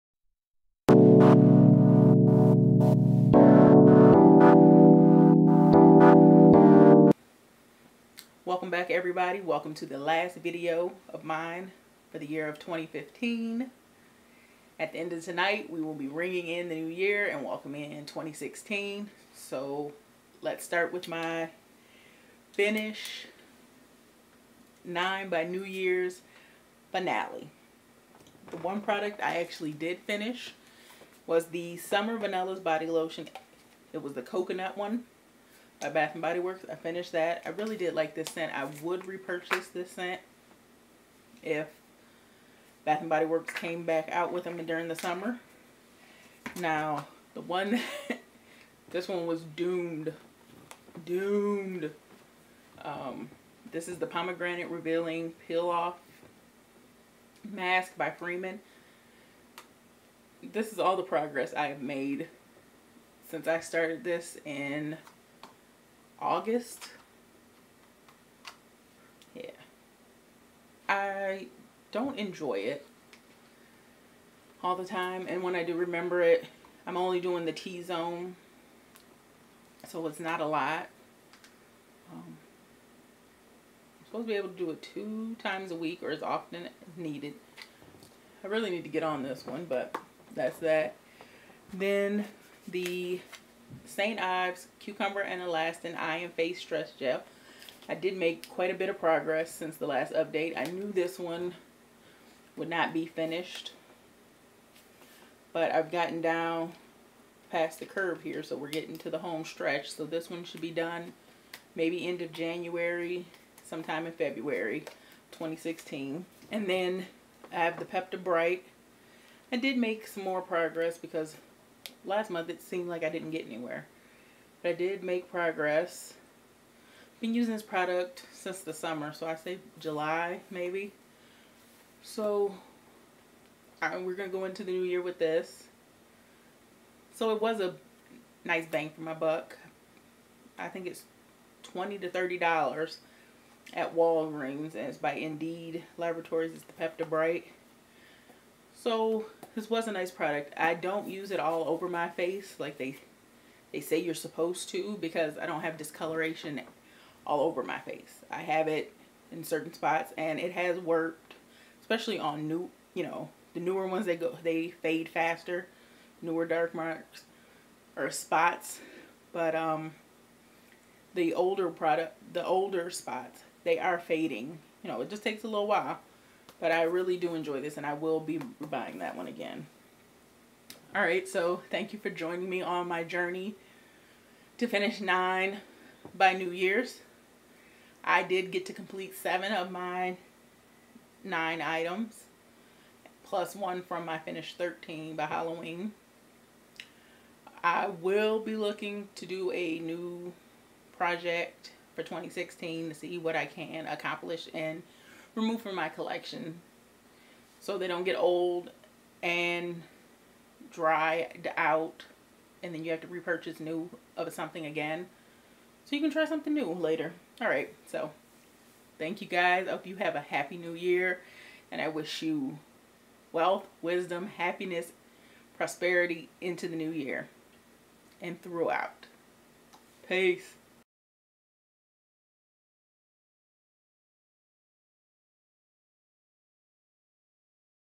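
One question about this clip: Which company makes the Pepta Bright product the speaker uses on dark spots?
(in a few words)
Indeed Laboratories.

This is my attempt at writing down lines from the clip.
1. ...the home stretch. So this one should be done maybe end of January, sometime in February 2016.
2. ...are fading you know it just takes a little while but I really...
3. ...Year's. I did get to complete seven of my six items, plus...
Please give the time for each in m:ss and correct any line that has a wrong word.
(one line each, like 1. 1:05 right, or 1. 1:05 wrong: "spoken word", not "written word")
1. 1:49 right
2. 2:53 right
3. 3:06 wrong: "nine", not "six".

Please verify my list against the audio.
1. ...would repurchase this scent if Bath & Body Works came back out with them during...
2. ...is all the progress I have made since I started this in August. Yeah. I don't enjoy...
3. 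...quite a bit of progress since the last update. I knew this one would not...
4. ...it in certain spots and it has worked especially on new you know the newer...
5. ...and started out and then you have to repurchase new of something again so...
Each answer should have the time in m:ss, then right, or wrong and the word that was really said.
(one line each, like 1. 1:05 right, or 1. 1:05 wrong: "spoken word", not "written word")
1. 0:38 right
2. 1:00 right
3. 1:38 right
4. 2:38 right
5. 3:29 wrong: "dried", not "started".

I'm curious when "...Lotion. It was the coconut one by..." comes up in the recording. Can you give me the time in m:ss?
0:32.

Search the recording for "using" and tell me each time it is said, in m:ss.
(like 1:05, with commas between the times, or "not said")
2:07.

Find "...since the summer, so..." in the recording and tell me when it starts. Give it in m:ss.
2:08.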